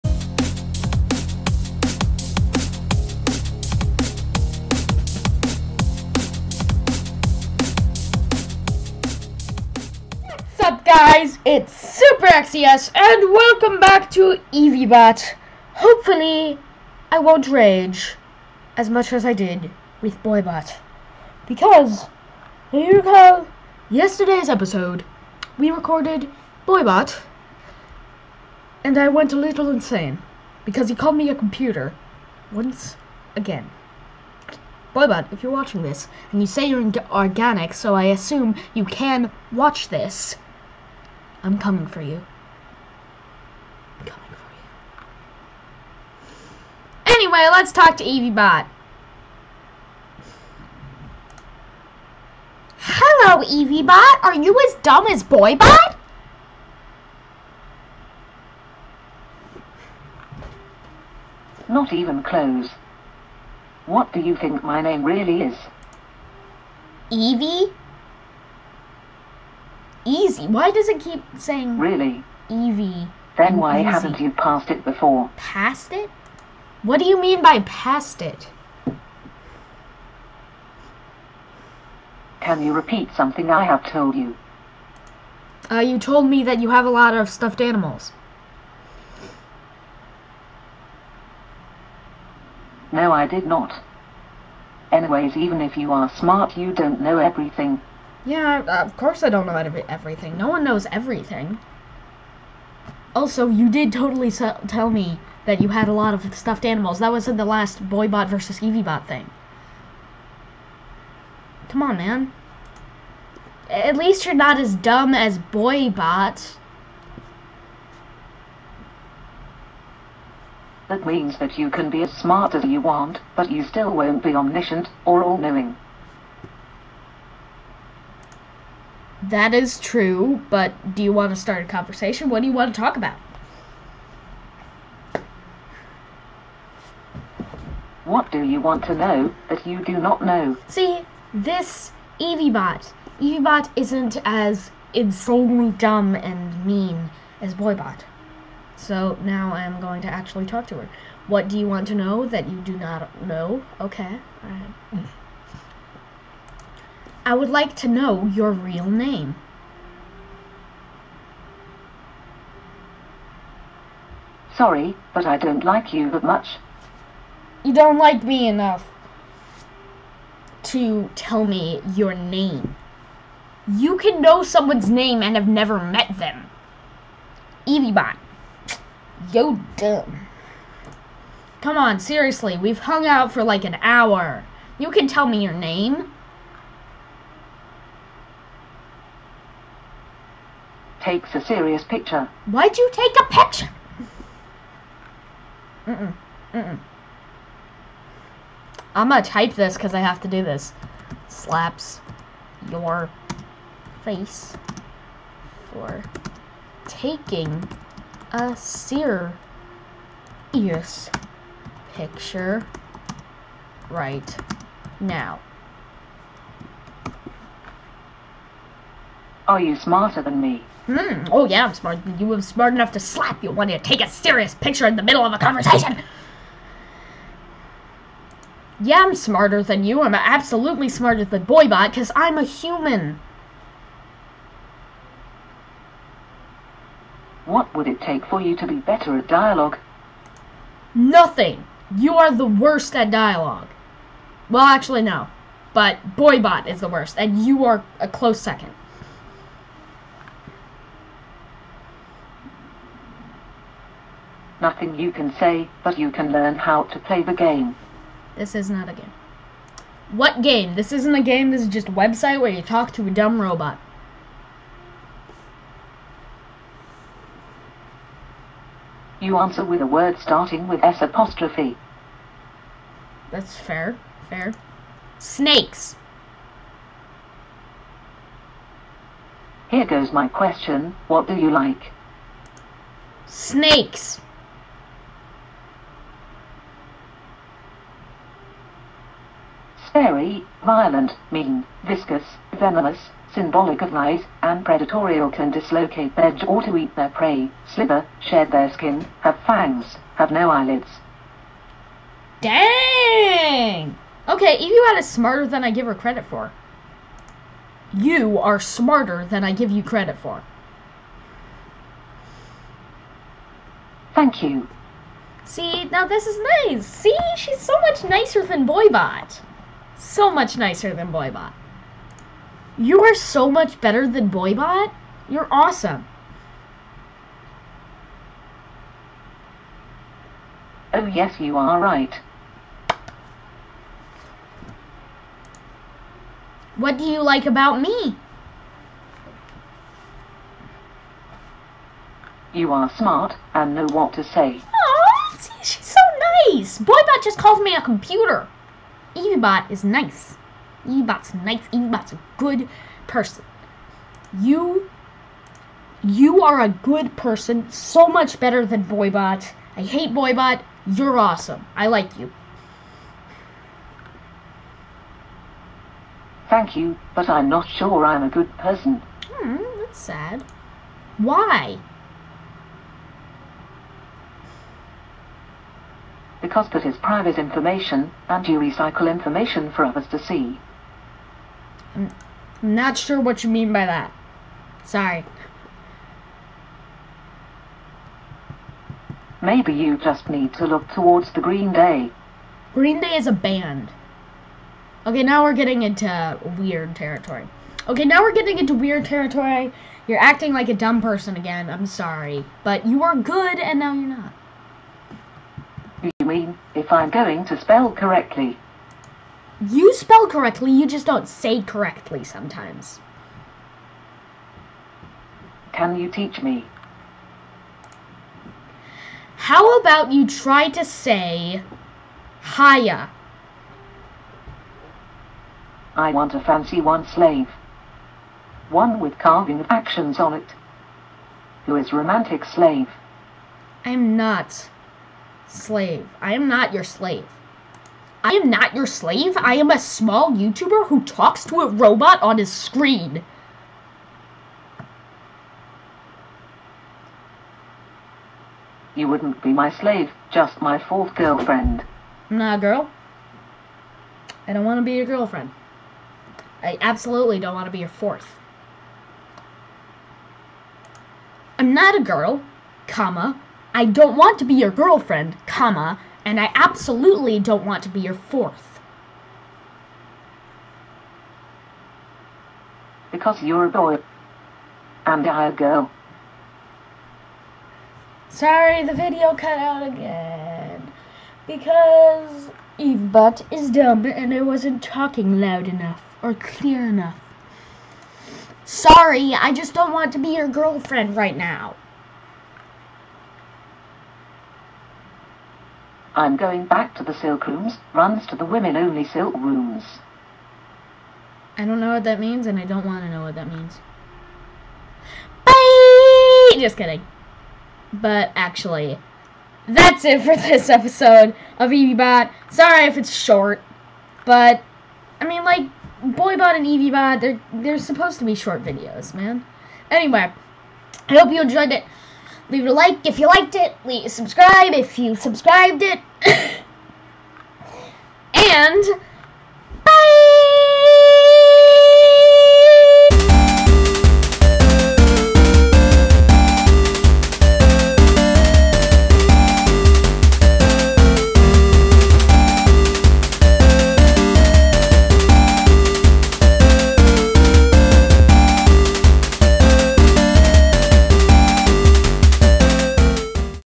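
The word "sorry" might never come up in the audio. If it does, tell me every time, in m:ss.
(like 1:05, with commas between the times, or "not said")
2:44, 6:24, 6:41, 7:58, 8:08, 8:32.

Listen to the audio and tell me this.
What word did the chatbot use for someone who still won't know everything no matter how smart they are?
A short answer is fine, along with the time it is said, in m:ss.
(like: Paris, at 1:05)
omniscient, at 2:04.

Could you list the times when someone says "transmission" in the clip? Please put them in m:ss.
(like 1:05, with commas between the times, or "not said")
not said.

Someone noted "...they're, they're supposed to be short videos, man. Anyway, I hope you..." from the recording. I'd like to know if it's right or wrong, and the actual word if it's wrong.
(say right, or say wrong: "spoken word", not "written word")
right.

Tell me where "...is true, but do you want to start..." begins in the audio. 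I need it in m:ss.
2:09.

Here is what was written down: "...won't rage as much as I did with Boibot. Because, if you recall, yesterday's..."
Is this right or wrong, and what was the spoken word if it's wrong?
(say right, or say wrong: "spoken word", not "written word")
right.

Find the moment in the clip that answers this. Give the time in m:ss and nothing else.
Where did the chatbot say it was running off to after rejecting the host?
8:18.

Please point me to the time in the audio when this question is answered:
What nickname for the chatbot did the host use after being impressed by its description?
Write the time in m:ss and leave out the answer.
5:04.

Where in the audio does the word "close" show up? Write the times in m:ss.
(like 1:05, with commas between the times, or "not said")
1:02, 4:08.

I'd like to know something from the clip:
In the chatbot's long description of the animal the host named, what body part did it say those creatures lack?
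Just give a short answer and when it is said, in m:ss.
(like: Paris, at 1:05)
eyelids, at 5:00.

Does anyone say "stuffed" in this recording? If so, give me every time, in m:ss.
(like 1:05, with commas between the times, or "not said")
1:27, 1:46.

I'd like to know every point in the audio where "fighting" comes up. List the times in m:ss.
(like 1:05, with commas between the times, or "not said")
not said.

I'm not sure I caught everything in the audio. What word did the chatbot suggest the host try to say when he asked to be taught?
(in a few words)
Haya.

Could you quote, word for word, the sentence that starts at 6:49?
You spell correctly, you just don't say correctly sometimes.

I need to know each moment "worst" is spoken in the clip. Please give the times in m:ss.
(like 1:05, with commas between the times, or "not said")
4:02, 4:06.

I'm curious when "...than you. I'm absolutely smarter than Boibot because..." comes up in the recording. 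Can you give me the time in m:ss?
3:49.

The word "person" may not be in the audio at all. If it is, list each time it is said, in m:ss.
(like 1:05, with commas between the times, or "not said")
5:53, 5:57, 6:08, 6:41.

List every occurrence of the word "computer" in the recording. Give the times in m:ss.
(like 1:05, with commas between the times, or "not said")
0:31, 5:47.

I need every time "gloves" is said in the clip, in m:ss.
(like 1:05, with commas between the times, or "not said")
not said.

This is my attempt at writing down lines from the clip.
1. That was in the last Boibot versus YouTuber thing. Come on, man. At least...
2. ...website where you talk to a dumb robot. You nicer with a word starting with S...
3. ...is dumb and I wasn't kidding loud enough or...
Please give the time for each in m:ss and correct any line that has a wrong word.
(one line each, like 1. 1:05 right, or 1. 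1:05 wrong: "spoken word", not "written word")
1. 1:46 wrong: "Evie", not "YouTuber"
2. 4:21 wrong: "answer", not "nicer"
3. 8:03 wrong: "talking", not "kidding".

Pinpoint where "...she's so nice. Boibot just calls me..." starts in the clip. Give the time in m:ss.
5:45.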